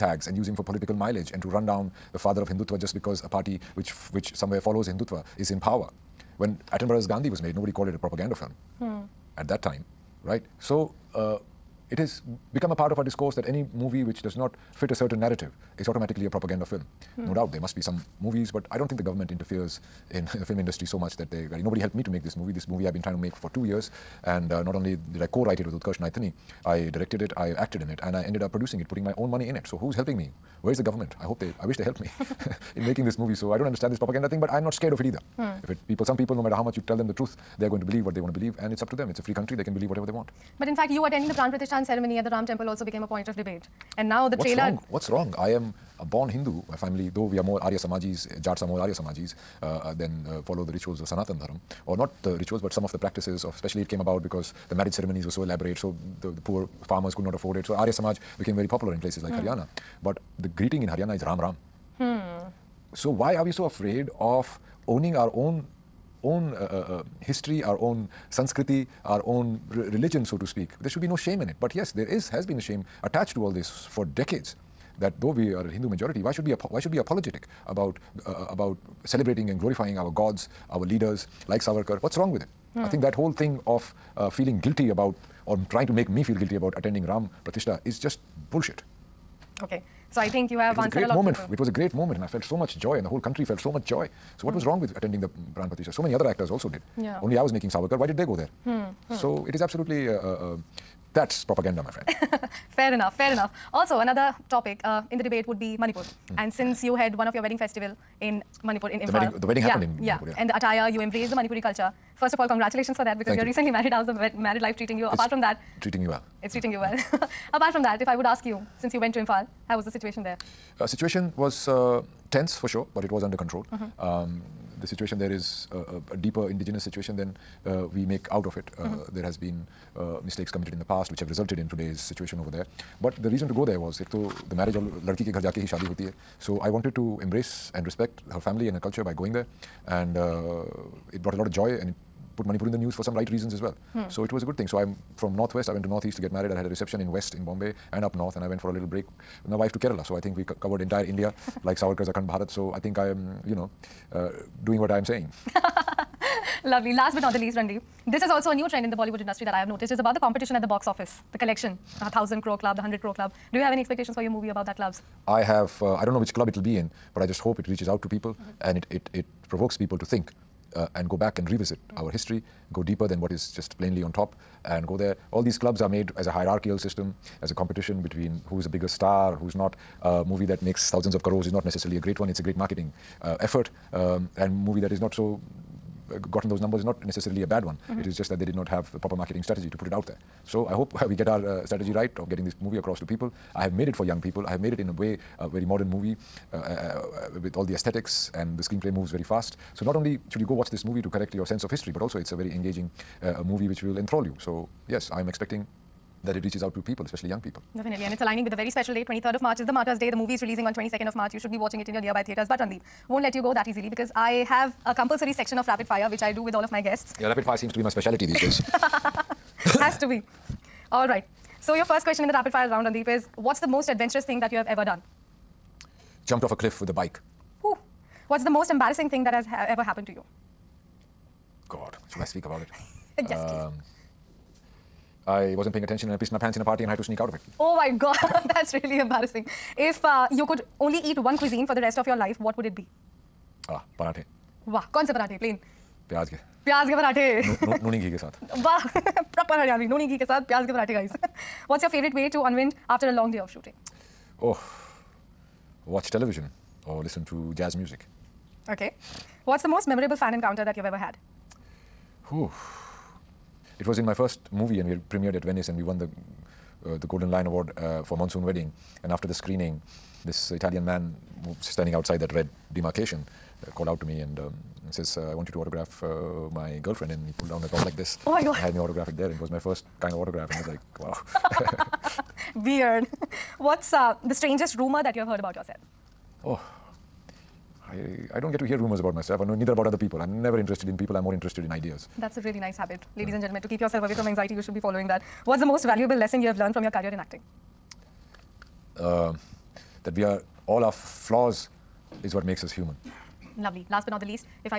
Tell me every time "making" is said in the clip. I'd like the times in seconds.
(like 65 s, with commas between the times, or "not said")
32 s, 97 s.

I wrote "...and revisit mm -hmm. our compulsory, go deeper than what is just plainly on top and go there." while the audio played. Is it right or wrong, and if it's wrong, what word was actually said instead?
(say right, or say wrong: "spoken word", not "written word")
wrong: "history", not "compulsory".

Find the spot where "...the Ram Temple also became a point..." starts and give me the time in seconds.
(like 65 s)
42 s.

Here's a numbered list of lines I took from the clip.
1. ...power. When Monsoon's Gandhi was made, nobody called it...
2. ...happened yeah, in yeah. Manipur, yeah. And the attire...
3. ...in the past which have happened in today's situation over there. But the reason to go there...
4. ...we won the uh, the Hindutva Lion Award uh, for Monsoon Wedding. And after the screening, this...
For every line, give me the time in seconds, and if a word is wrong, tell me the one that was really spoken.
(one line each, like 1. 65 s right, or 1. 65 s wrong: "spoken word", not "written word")
1. 5 s wrong: "Attenborough", not "Monsoon"
2. 109 s right
3. 130 s wrong: "resulted", not "happened"
4. 265 s wrong: "Golden", not "Hindutva".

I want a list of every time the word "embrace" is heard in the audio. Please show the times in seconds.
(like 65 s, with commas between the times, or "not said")
110 s, 137 s.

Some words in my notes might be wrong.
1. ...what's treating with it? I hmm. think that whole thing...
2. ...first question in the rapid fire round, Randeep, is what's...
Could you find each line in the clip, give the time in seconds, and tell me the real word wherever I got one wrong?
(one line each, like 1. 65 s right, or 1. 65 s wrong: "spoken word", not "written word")
1. 82 s wrong: "wrong", not "treating"
2. 221 s right.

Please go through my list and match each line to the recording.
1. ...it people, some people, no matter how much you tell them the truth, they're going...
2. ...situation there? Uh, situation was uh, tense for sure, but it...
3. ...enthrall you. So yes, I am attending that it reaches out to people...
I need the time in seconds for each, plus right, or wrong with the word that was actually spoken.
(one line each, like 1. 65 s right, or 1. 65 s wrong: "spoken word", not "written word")
1. 35 s right
2. 119 s right
3. 203 s wrong: "expecting", not "attending".